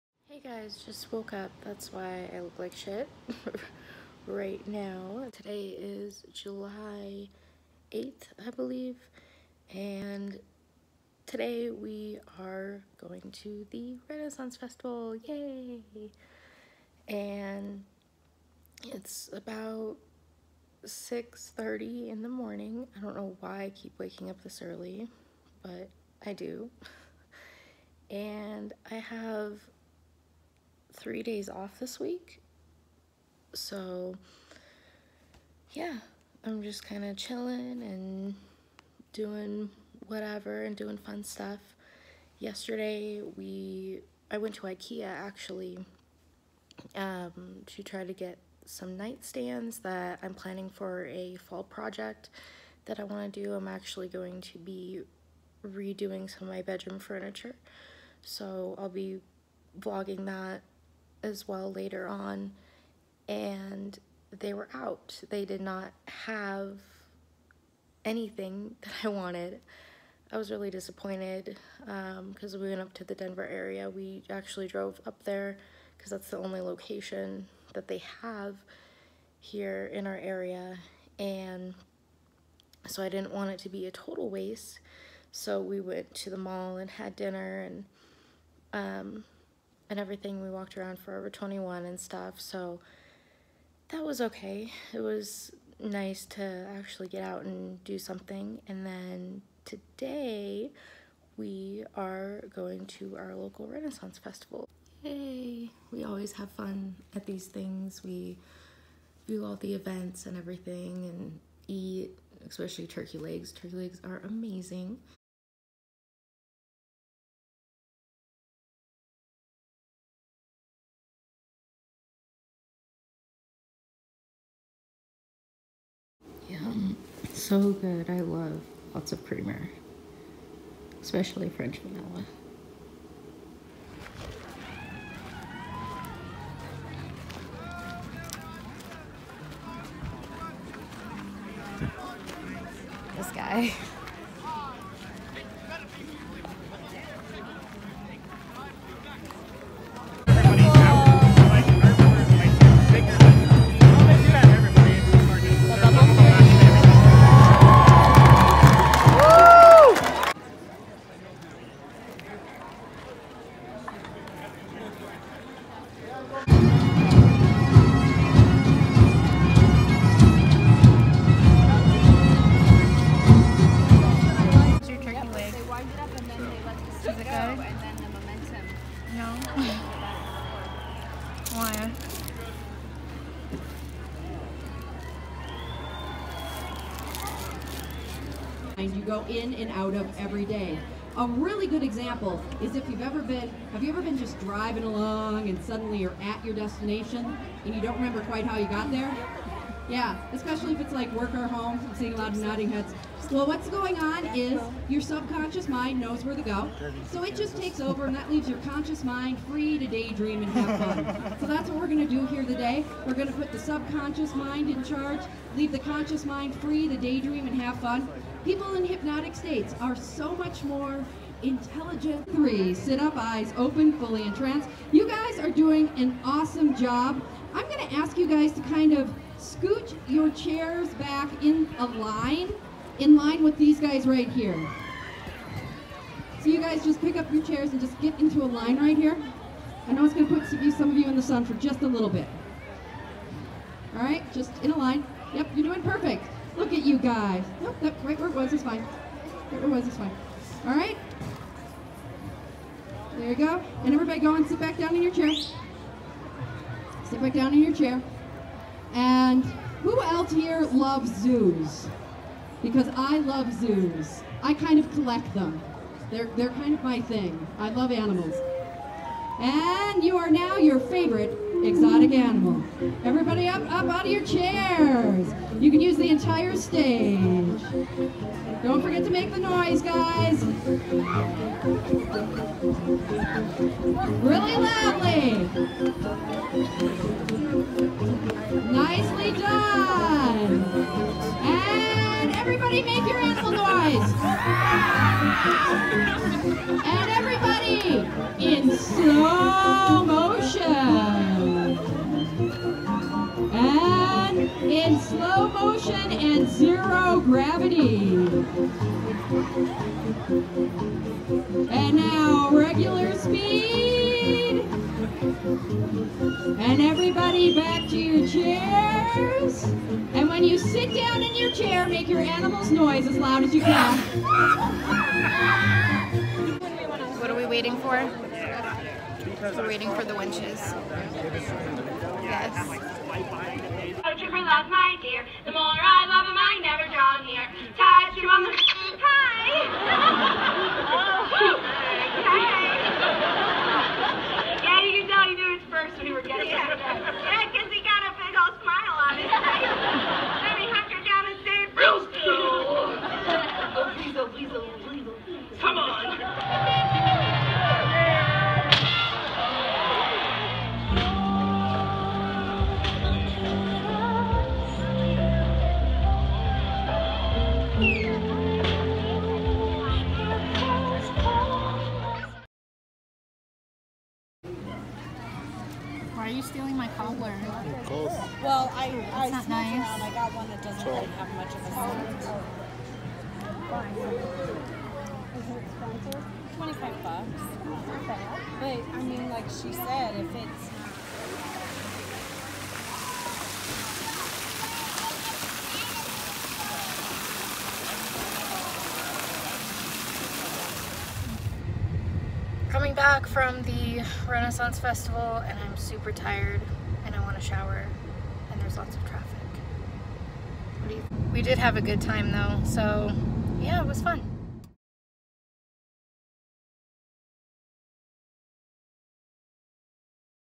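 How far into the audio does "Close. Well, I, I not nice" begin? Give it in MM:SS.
06:17.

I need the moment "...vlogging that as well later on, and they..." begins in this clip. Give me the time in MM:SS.
00:59.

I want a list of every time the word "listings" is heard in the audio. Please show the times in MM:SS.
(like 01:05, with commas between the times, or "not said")
not said.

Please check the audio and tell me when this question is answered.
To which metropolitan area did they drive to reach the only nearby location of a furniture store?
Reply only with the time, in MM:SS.
01:13.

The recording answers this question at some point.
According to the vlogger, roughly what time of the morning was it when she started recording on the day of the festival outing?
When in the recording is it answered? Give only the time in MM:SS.
00:20.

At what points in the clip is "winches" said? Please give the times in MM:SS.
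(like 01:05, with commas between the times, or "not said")
05:30.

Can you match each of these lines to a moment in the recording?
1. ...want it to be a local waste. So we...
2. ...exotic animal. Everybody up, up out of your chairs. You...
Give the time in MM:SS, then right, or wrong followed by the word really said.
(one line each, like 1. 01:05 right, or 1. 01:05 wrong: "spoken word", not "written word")
1. 01:23 wrong: "total", not "local"
2. 04:31 right.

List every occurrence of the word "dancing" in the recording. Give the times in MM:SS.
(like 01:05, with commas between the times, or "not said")
not said.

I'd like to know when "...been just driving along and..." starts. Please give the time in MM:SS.
03:14.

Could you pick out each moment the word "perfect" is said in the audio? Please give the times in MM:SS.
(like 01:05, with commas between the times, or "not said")
04:05.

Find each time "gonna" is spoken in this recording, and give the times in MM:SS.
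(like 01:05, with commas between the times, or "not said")
03:47, 04:00.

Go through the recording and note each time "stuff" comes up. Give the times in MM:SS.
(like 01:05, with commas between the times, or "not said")
00:41, 01:31.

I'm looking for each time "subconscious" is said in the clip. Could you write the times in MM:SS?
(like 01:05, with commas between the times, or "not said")
03:25, 03:33.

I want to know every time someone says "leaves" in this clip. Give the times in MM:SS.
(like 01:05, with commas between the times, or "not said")
03:28, 03:35.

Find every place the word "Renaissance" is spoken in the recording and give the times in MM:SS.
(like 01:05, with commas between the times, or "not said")
00:14, 01:43, 06:44.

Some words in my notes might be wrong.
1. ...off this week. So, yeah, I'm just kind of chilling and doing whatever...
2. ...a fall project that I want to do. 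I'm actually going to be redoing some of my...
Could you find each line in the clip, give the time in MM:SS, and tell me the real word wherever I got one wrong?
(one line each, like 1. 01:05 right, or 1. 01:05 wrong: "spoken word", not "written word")
1. 00:31 right
2. 00:51 right.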